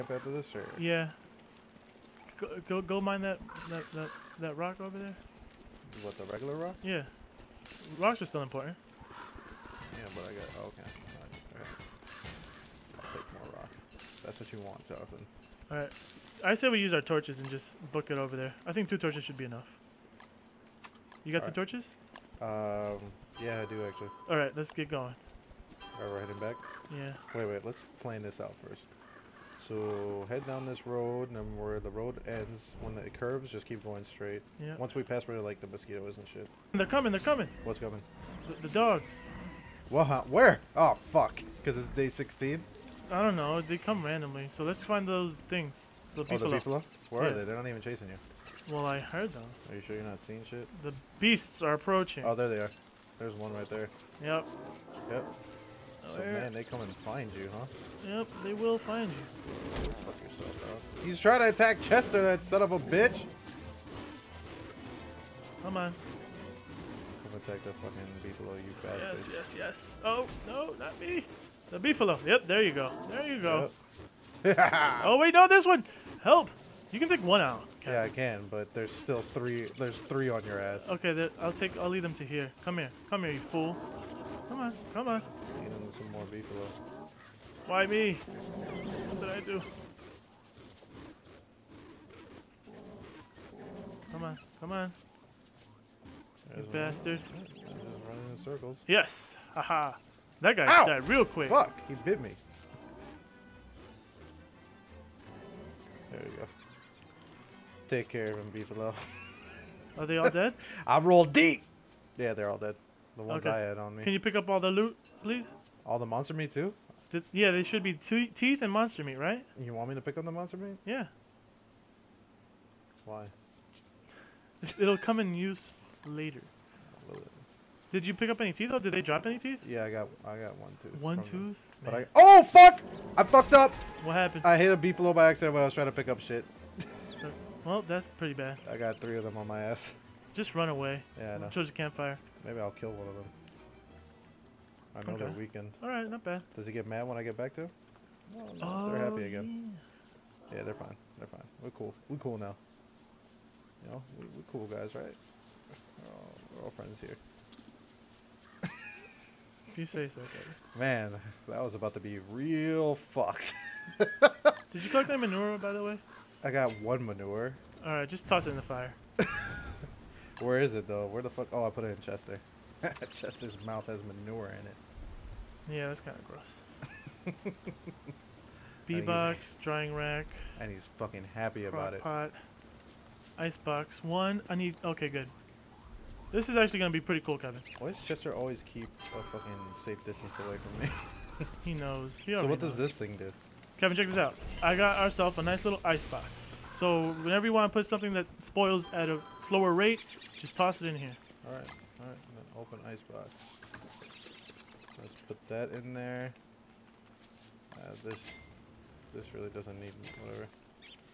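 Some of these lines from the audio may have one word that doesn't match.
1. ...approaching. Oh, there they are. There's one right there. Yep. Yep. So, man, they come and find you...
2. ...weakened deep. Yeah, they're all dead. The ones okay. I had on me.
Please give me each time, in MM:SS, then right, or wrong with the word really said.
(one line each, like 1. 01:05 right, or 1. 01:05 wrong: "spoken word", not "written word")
1. 00:51 right
2. 01:50 wrong: "rolled", not "weakened".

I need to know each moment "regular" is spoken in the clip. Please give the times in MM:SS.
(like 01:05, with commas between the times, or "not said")
00:06.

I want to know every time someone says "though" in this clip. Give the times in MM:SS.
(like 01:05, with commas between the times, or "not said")
02:08, 02:50.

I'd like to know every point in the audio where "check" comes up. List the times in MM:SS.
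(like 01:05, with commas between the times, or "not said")
03:13.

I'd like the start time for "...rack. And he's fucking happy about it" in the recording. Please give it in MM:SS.
02:59.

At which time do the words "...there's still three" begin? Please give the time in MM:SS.
01:18.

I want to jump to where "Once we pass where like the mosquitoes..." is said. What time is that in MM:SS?
00:34.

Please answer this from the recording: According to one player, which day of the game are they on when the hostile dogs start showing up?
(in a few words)
Day 16.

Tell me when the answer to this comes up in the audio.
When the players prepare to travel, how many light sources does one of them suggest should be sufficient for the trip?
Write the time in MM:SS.
00:18.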